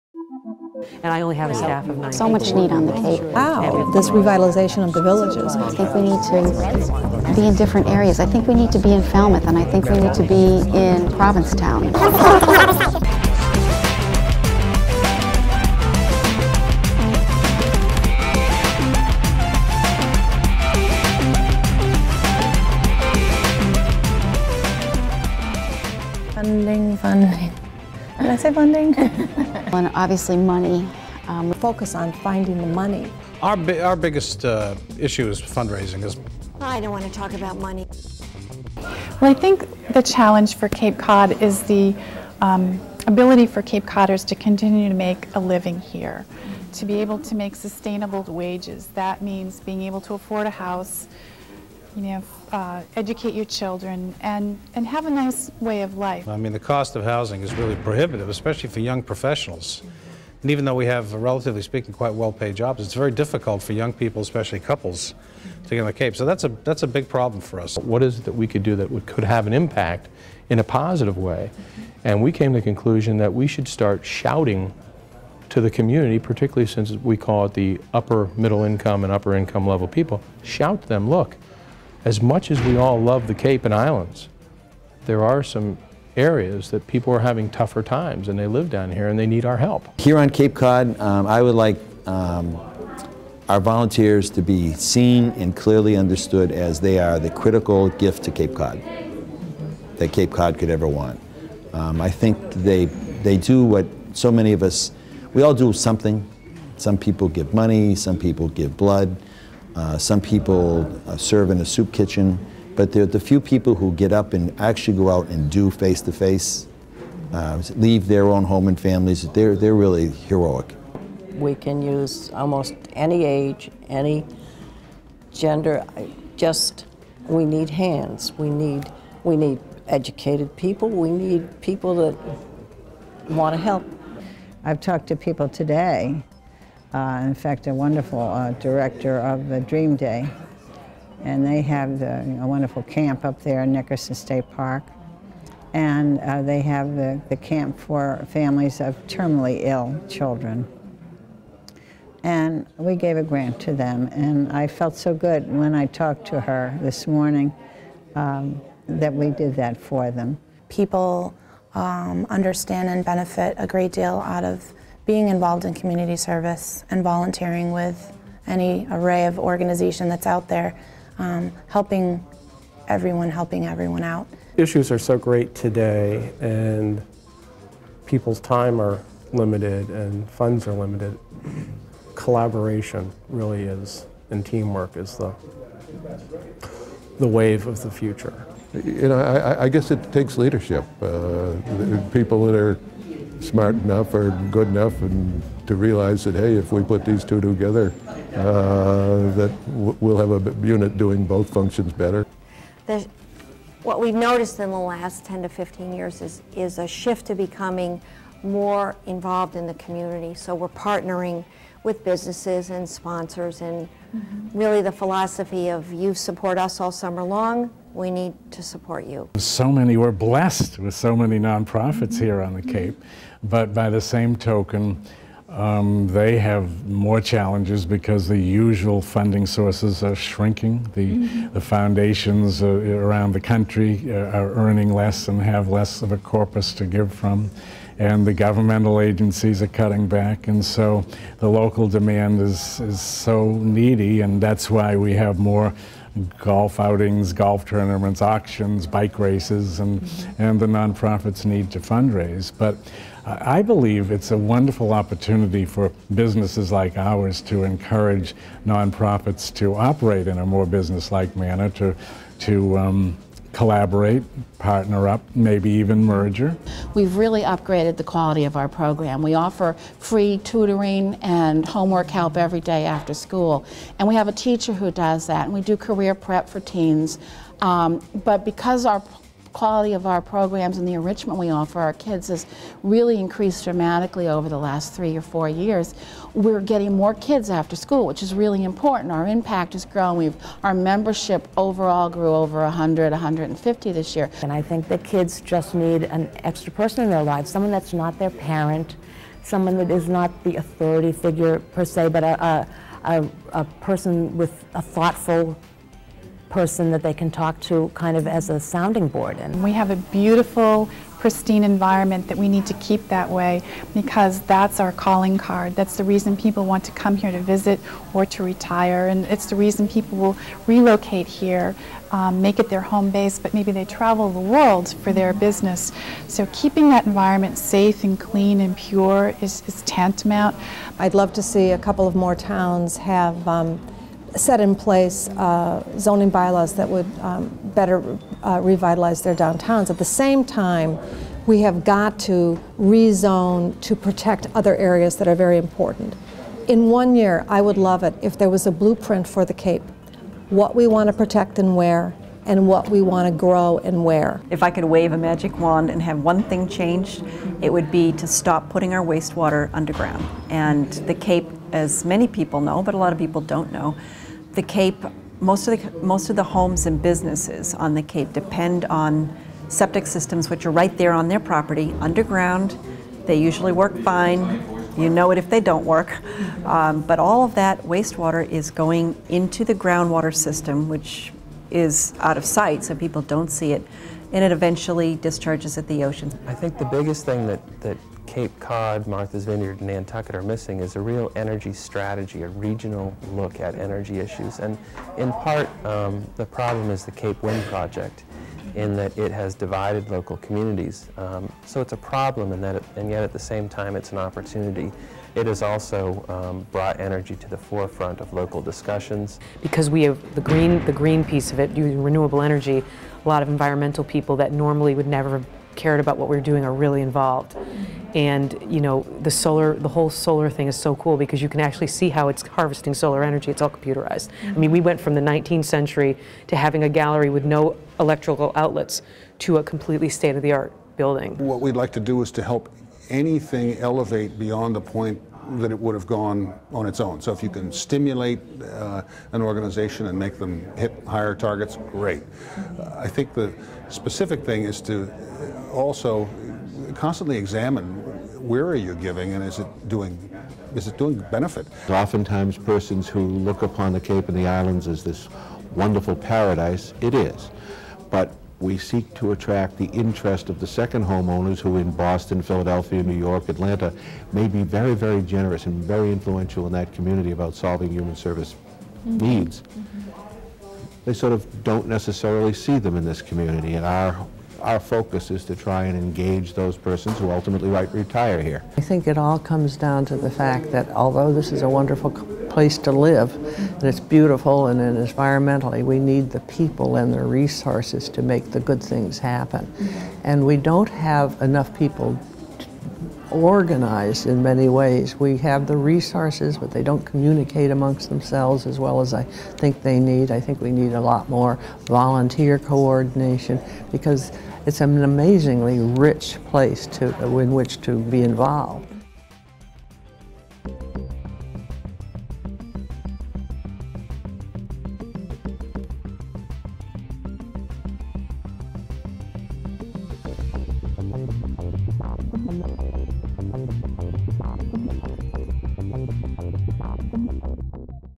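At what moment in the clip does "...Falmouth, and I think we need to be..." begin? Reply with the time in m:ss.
0:09.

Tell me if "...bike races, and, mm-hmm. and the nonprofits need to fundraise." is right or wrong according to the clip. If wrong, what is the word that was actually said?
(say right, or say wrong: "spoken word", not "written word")
right.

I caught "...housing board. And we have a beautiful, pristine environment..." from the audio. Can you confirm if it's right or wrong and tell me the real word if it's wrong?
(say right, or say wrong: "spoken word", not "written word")
wrong: "sounding", not "housing".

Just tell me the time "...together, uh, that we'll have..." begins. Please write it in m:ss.
3:17.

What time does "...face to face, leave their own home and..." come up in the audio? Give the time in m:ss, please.
1:55.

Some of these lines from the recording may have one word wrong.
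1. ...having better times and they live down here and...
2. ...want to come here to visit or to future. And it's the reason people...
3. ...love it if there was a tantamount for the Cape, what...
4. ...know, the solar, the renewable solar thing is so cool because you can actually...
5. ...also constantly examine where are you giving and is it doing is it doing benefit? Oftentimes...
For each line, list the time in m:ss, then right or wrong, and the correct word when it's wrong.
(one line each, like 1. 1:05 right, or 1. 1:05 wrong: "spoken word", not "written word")
1. 1:27 wrong: "tougher", not "better"
2. 5:16 wrong: "retire", not "future"
3. 5:47 wrong: "blueprint", not "tantamount"
4. 6:58 wrong: "whole", not "renewable"
5. 7:25 right.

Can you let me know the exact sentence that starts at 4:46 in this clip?
We're getting more kids after school, which is really important.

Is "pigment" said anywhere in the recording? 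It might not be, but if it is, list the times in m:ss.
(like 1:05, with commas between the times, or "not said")
not said.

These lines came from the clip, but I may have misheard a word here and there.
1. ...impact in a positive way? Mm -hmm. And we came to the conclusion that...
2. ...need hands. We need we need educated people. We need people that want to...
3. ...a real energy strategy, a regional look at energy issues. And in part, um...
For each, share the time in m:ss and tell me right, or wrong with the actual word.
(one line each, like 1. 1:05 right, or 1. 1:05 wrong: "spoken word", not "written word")
1. 1:09 right
2. 2:07 right
3. 6:30 right.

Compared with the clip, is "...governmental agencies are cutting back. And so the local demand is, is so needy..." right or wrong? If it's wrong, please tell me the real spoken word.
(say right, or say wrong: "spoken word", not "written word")
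right.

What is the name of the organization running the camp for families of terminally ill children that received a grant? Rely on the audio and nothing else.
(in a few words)
Dream Day.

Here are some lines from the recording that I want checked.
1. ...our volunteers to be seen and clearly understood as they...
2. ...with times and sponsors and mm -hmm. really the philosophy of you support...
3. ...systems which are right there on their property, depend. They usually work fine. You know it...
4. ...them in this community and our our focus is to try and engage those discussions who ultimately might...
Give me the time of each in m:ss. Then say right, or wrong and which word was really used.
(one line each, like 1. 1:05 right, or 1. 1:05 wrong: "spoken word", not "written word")
1. 1:33 right
2. 3:31 wrong: "businesses", not "times"
3. 6:10 wrong: "underground", not "depend"
4. 7:52 wrong: "persons", not "discussions".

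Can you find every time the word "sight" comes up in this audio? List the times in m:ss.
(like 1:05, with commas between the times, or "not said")
6:22.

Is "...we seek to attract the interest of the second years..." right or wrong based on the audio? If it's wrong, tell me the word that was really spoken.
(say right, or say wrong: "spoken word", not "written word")
wrong: "homeowners", not "years".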